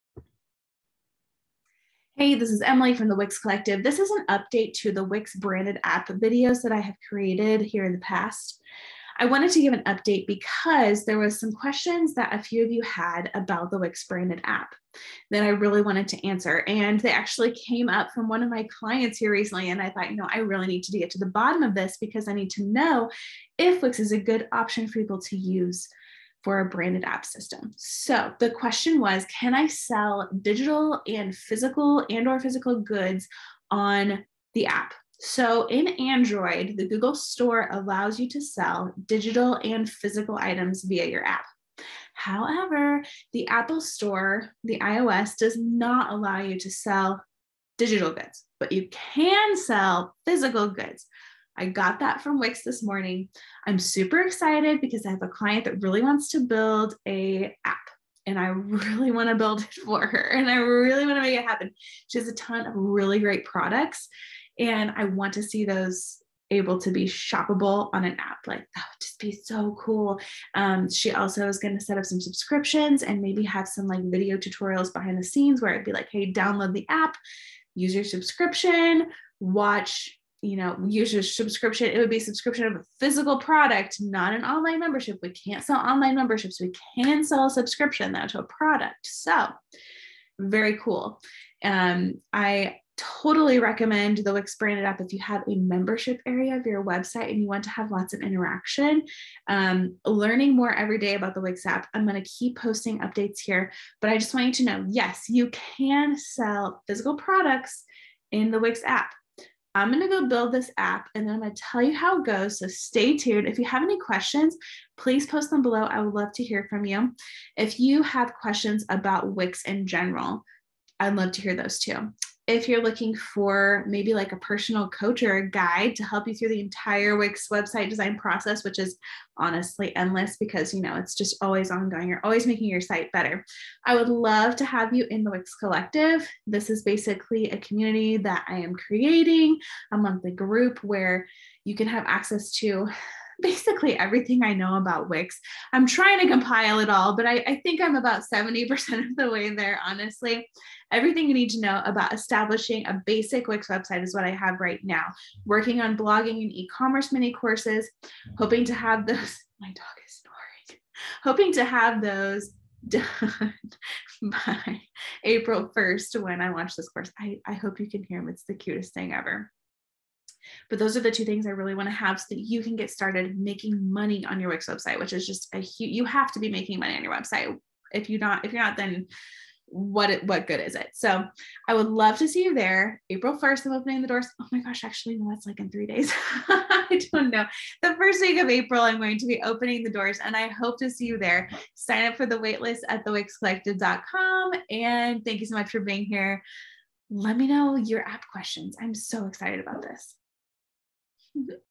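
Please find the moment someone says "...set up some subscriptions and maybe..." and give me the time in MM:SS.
01:11.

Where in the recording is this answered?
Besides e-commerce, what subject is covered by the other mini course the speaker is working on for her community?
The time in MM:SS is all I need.
02:35.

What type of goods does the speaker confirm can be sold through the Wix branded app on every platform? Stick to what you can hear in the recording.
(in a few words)
physical products.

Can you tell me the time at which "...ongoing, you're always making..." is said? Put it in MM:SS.
02:11.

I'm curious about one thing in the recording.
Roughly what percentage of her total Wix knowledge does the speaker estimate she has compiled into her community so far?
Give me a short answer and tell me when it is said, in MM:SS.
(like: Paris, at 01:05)
70%, at 02:28.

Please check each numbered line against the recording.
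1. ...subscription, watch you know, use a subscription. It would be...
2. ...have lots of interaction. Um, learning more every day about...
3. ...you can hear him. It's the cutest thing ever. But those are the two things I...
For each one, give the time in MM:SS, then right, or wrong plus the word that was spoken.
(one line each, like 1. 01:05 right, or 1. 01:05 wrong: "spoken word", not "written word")
1. 01:18 right
2. 01:37 right
3. 02:47 right.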